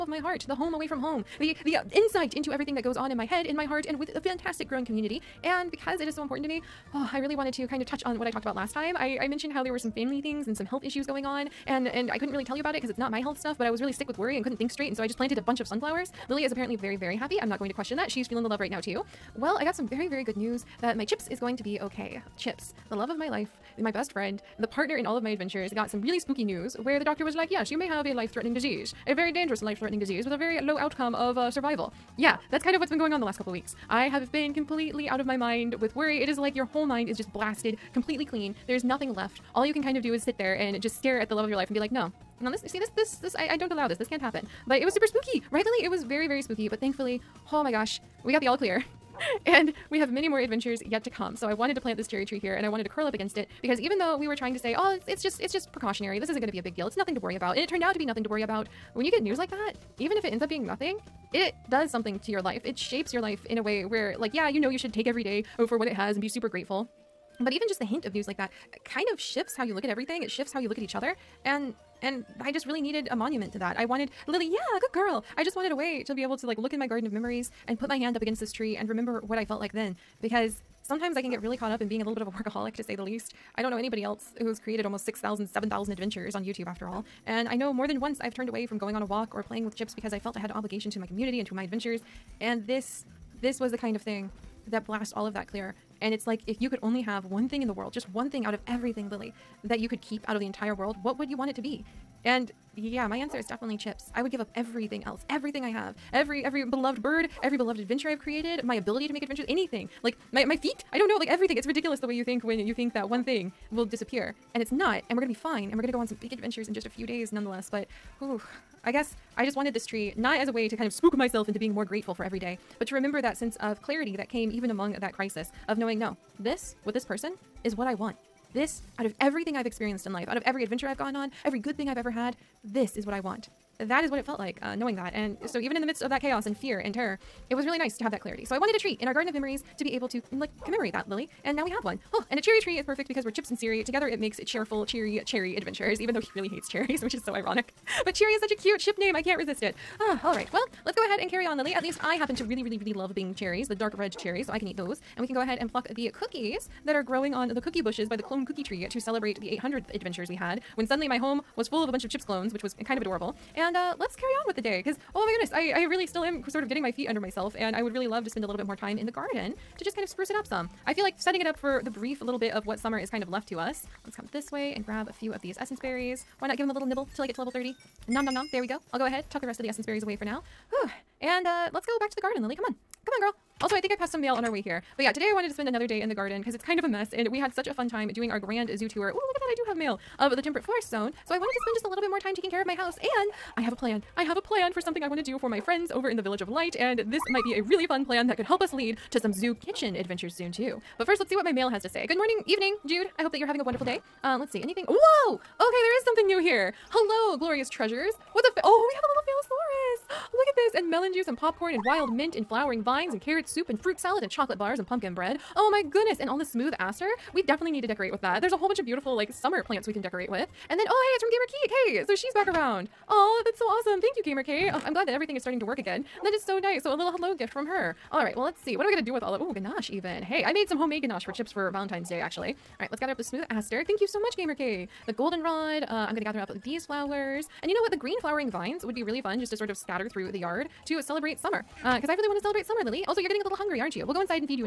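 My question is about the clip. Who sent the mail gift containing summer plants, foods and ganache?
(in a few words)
Gamer Keek.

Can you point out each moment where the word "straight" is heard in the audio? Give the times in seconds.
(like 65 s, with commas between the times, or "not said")
14 s.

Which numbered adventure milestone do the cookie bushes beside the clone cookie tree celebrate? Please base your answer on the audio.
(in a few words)
800.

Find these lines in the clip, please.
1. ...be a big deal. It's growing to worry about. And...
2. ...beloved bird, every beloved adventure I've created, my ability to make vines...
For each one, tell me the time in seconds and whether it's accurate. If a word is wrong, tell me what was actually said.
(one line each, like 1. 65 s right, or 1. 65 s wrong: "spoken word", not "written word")
1. 56 s wrong: "nothing", not "growing"
2. 106 s wrong: "adventures", not "vines".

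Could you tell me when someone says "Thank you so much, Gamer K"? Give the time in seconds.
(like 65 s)
233 s.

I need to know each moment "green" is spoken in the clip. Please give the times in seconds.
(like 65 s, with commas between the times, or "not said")
237 s.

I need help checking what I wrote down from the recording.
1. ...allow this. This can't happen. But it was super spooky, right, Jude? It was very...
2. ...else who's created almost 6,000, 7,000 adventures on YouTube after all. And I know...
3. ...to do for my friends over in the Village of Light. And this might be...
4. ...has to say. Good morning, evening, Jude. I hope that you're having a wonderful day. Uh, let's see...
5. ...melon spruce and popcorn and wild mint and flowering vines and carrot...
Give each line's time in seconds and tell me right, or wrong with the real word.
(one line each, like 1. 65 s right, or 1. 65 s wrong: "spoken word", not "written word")
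1. 43 s wrong: "Lily", not "Jude"
2. 84 s right
3. 195 s right
4. 201 s right
5. 210 s wrong: "juice", not "spruce".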